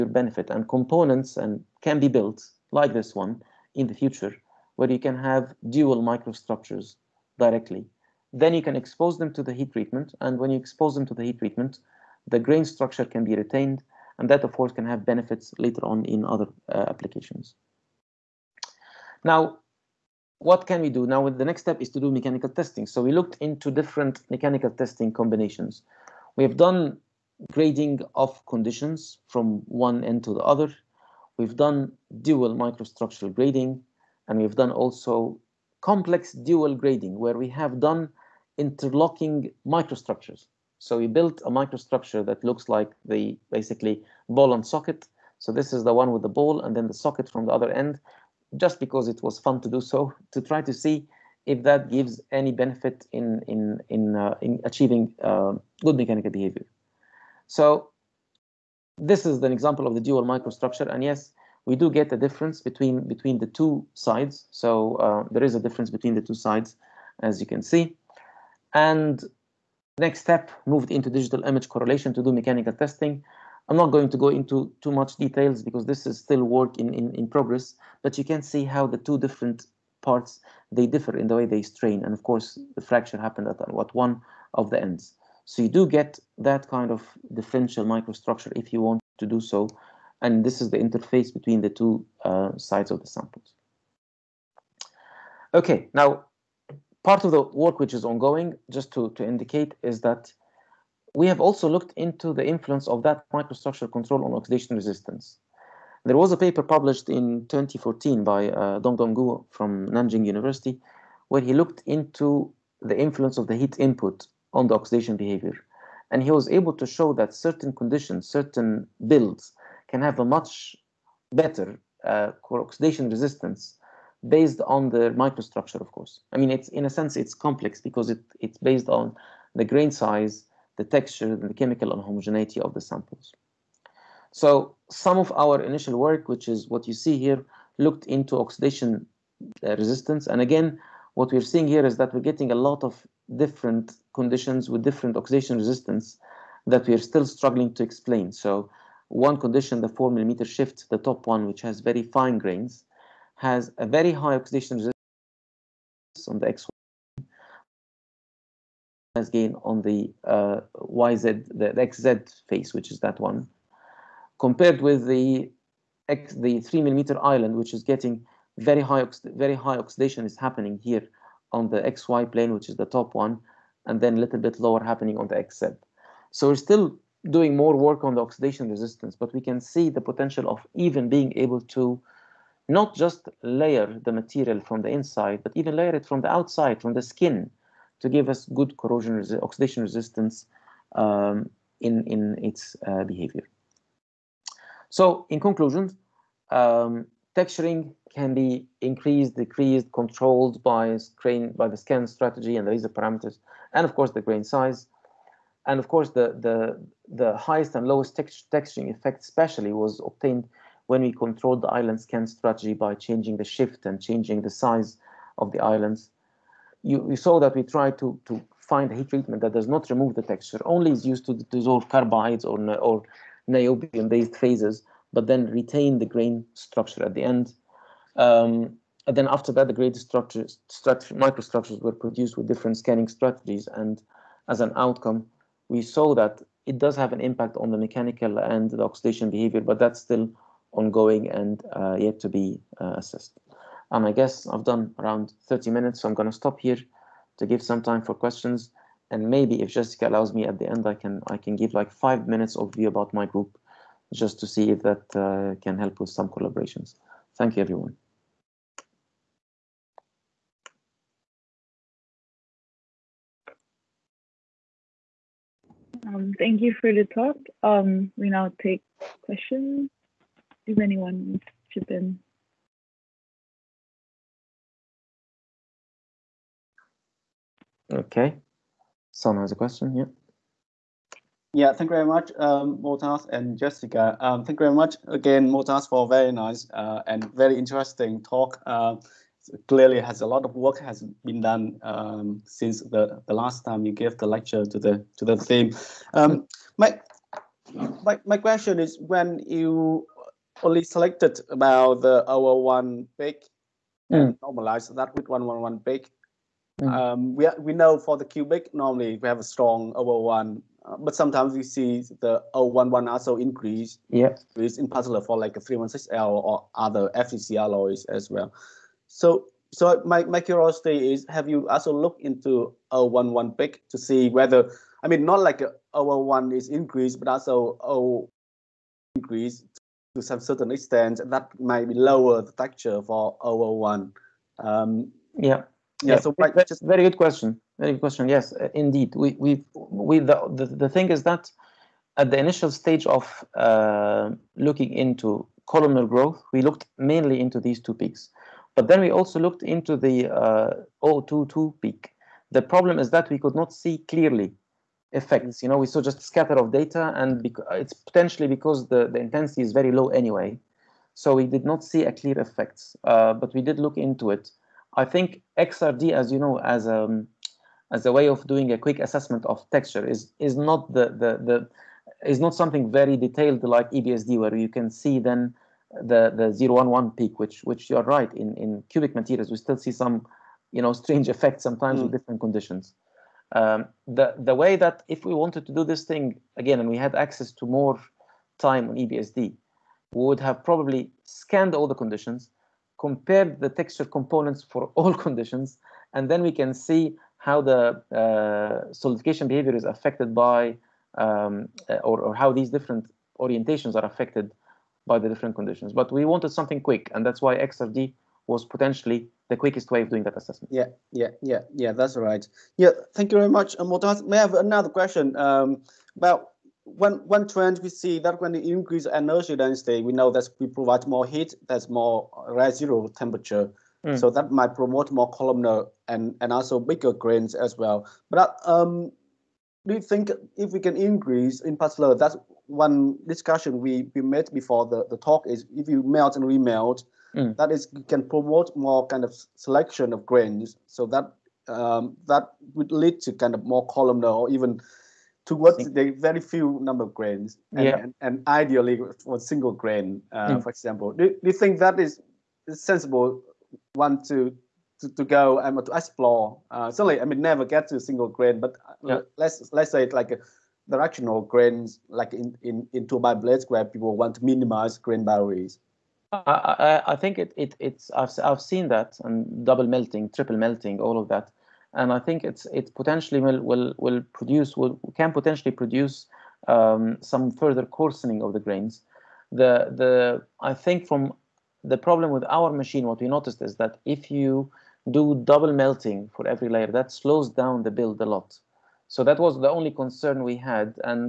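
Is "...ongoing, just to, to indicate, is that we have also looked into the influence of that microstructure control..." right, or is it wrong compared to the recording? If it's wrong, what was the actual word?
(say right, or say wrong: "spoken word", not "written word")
right.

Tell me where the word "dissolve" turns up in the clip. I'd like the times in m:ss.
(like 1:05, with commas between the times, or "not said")
3:41.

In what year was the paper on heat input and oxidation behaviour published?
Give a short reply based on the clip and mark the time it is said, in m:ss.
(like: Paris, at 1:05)
2014, at 1:47.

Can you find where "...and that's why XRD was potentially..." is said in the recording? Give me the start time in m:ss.
6:47.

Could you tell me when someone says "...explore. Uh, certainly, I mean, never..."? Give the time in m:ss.
7:35.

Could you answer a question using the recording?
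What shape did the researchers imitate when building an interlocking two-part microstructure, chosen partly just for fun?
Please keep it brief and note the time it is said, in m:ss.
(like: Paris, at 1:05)
Ball and socket, at 0:44.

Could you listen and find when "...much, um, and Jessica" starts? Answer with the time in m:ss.
4:42.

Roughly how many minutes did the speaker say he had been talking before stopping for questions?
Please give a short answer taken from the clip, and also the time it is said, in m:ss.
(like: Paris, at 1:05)
30 minutes, at 4:04.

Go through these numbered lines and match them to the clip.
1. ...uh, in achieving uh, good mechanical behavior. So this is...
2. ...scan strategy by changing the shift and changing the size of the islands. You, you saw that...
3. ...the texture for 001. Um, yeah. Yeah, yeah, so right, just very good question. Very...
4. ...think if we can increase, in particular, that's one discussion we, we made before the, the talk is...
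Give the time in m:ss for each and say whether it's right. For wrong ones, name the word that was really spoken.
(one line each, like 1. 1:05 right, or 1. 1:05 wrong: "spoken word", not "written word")
1. 0:54 right
2. 3:32 right
3. 5:32 right
4. 7:10 right.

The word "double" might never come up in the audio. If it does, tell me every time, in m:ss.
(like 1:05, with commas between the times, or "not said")
7:49, 8:05.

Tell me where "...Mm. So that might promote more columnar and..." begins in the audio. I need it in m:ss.
7:04.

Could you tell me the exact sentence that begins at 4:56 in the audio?
Um, my, my my question is when you only selected about the our one big mm.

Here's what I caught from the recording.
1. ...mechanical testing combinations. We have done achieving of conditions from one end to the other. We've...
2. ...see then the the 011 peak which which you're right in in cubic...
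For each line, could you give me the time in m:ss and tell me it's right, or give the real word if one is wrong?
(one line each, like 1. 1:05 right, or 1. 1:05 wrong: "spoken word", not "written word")
1. 0:24 wrong: "grading", not "achieving"
2. 6:14 right.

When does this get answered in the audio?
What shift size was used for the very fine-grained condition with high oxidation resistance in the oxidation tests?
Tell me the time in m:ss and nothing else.
2:29.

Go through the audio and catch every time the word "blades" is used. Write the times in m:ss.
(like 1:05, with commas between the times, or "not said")
7:43.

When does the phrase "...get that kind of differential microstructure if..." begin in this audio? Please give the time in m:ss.
1:25.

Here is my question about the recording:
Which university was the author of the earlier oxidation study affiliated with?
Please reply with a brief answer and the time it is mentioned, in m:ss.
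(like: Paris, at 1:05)
Nanjing University, at 1:49.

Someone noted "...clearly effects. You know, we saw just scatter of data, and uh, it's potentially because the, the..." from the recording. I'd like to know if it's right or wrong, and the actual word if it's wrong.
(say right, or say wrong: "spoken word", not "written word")
right.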